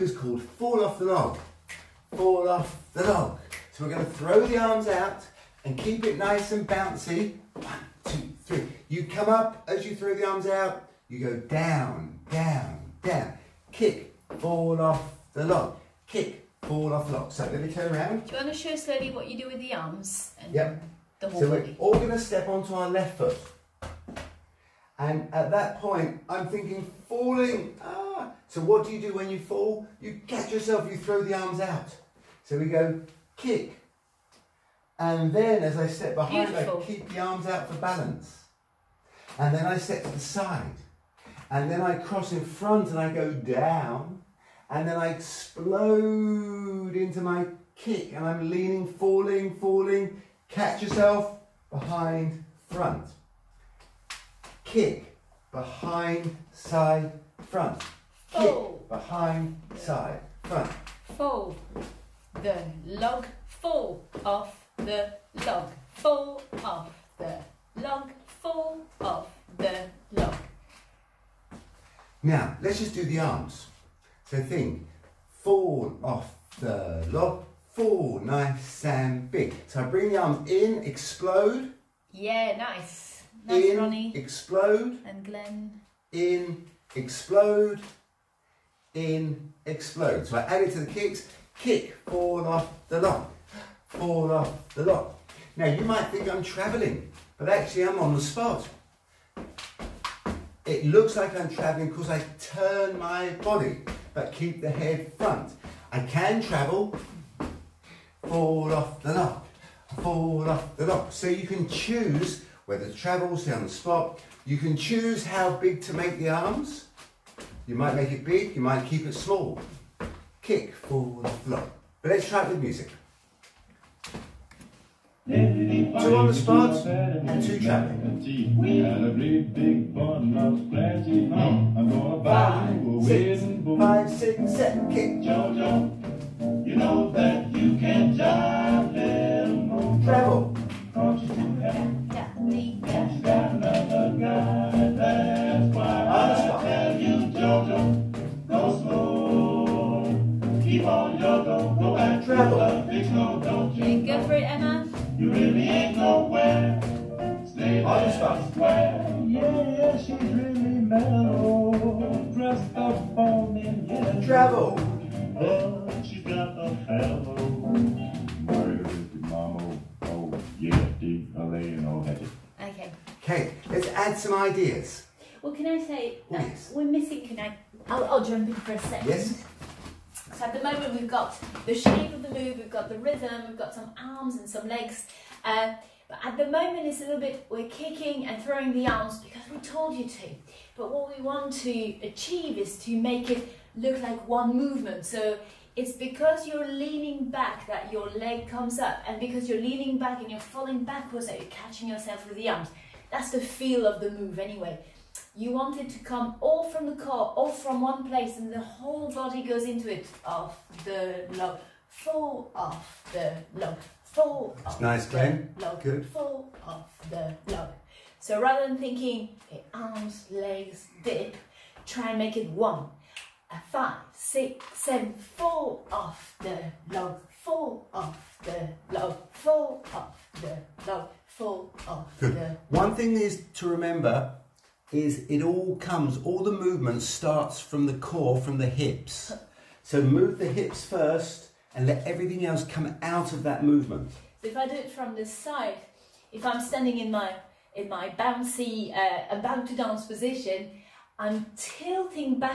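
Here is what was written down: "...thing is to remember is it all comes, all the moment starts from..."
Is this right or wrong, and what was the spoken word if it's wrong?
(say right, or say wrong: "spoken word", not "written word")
wrong: "movement", not "moment".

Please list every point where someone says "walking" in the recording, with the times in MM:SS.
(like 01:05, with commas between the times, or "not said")
not said.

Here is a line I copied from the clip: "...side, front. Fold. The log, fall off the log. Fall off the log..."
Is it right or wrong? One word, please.
right.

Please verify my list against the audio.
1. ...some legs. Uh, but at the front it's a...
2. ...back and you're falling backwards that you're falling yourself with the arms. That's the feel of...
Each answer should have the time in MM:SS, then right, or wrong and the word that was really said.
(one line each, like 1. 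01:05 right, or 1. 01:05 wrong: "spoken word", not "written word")
1. 03:04 wrong: "moment", not "front"
2. 03:19 wrong: "catching", not "falling".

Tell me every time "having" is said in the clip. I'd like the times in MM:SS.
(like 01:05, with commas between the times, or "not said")
not said.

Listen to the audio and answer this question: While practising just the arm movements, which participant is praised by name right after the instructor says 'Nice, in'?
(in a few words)
Ronnie.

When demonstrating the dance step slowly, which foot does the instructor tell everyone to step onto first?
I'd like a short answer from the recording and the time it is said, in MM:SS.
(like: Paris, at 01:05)
left foot, at 00:22.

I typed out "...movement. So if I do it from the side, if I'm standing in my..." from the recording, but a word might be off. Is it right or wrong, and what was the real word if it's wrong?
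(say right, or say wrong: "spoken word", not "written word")
right.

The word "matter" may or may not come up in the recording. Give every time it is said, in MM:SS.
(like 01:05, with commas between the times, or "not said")
not said.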